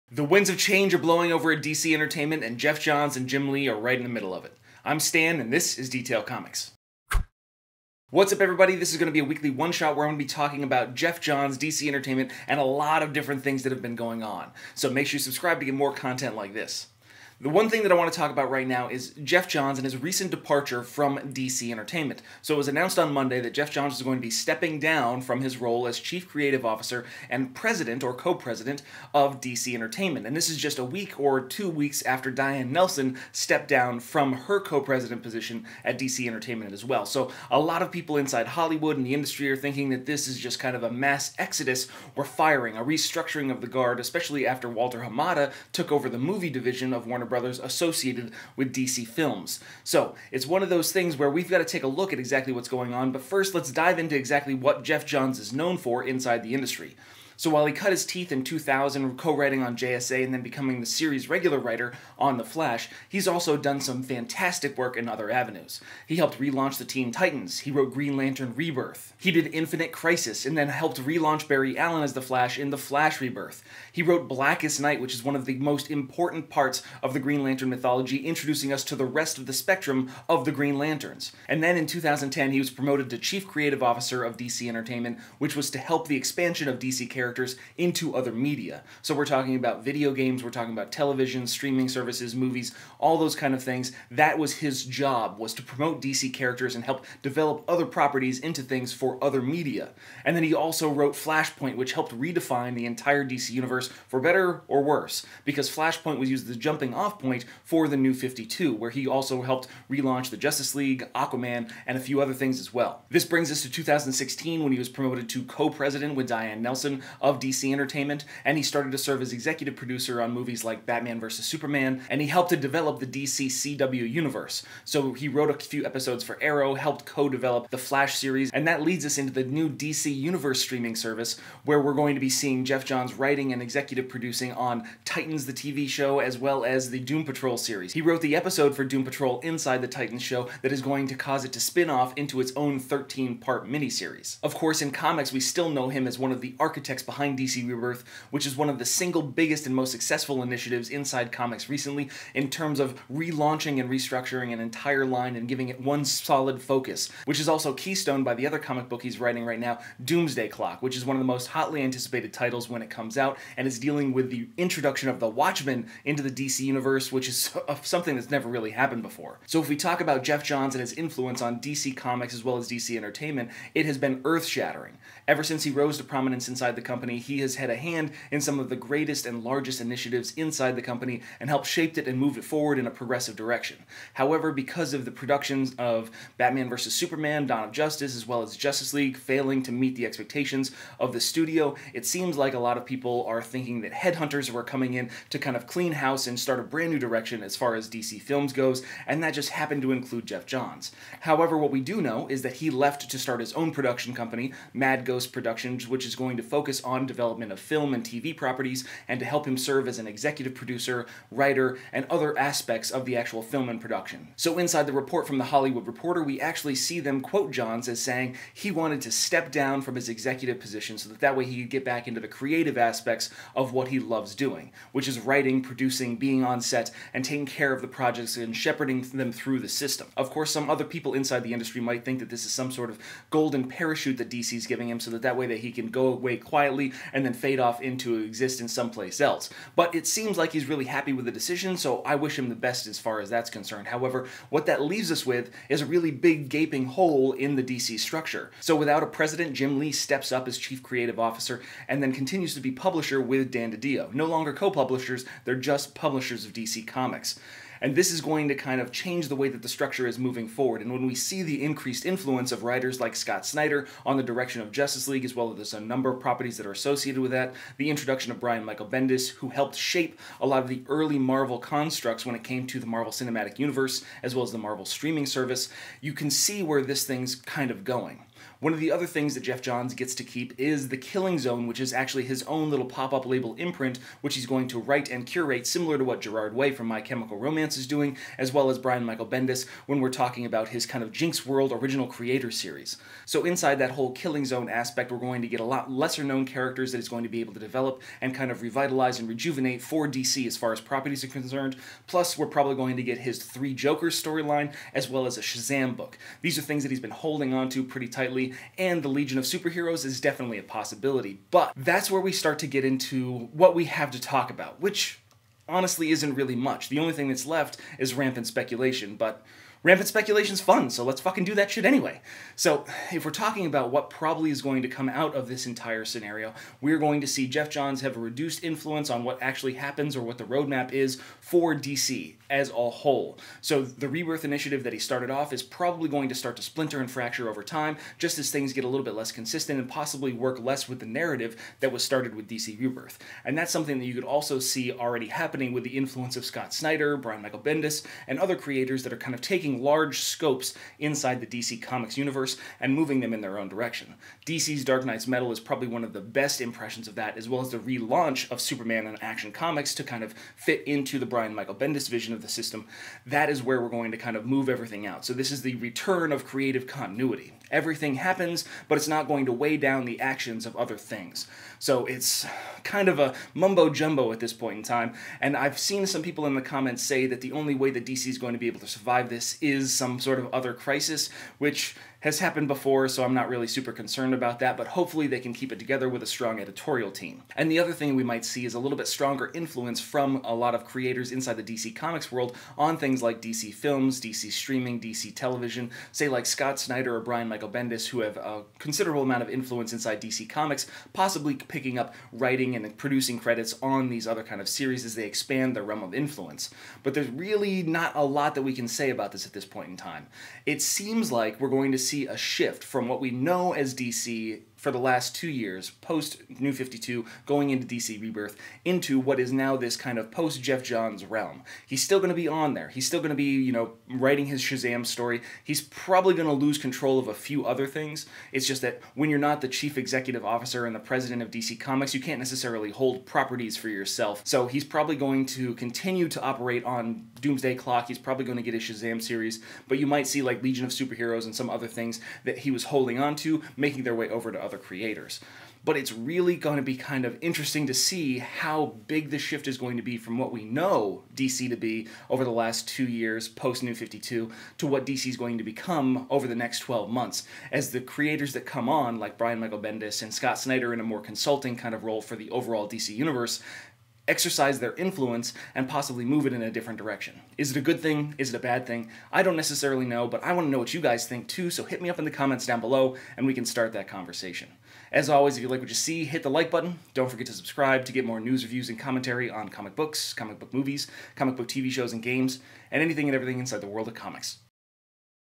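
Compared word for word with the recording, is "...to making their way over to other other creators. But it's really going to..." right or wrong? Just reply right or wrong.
right.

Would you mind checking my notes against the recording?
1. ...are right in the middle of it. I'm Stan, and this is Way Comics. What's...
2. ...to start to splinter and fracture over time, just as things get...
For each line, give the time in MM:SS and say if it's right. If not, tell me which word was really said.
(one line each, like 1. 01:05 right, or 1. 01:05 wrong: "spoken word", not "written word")
1. 00:03 wrong: "Detail", not "Way"
2. 05:36 right.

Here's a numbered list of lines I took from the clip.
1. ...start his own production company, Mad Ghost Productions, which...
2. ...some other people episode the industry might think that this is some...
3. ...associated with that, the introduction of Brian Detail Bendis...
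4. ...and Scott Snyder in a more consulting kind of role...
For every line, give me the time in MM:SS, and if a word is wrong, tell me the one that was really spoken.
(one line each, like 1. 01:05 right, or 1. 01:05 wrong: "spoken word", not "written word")
1. 03:23 right
2. 03:50 wrong: "inside", not "episode"
3. 04:26 wrong: "Michael", not "Detail"
4. 07:40 right.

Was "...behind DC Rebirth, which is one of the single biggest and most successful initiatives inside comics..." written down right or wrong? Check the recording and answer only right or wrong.
right.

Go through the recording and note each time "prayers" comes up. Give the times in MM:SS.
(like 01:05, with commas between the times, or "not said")
not said.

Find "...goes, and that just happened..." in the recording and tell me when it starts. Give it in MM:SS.
03:18.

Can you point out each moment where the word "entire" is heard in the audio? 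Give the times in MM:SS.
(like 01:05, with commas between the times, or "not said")
01:42, 02:34, 05:25.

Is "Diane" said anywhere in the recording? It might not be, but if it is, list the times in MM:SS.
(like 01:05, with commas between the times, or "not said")
00:32, 01:56.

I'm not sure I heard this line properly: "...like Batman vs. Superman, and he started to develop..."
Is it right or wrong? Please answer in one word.
wrong.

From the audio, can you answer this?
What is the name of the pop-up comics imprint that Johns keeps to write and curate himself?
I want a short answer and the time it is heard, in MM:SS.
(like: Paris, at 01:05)
The Killing Zone, at 04:40.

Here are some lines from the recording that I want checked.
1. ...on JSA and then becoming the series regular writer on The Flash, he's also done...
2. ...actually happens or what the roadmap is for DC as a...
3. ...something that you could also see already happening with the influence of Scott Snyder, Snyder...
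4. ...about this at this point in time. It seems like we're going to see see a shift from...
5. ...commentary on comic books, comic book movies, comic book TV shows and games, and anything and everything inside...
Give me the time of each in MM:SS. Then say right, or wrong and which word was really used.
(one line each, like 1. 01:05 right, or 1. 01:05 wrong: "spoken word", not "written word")
1. 00:59 right
2. 05:29 right
3. 05:43 wrong: "Brian", not "Snyder"
4. 06:49 right
5. 07:58 right.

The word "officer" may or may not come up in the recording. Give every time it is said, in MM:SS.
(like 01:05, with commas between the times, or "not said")
00:26, 01:23, 04:11, 07:10.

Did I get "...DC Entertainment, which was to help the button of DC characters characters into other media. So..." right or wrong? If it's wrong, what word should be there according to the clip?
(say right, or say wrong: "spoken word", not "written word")
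wrong: "expansion", not "button".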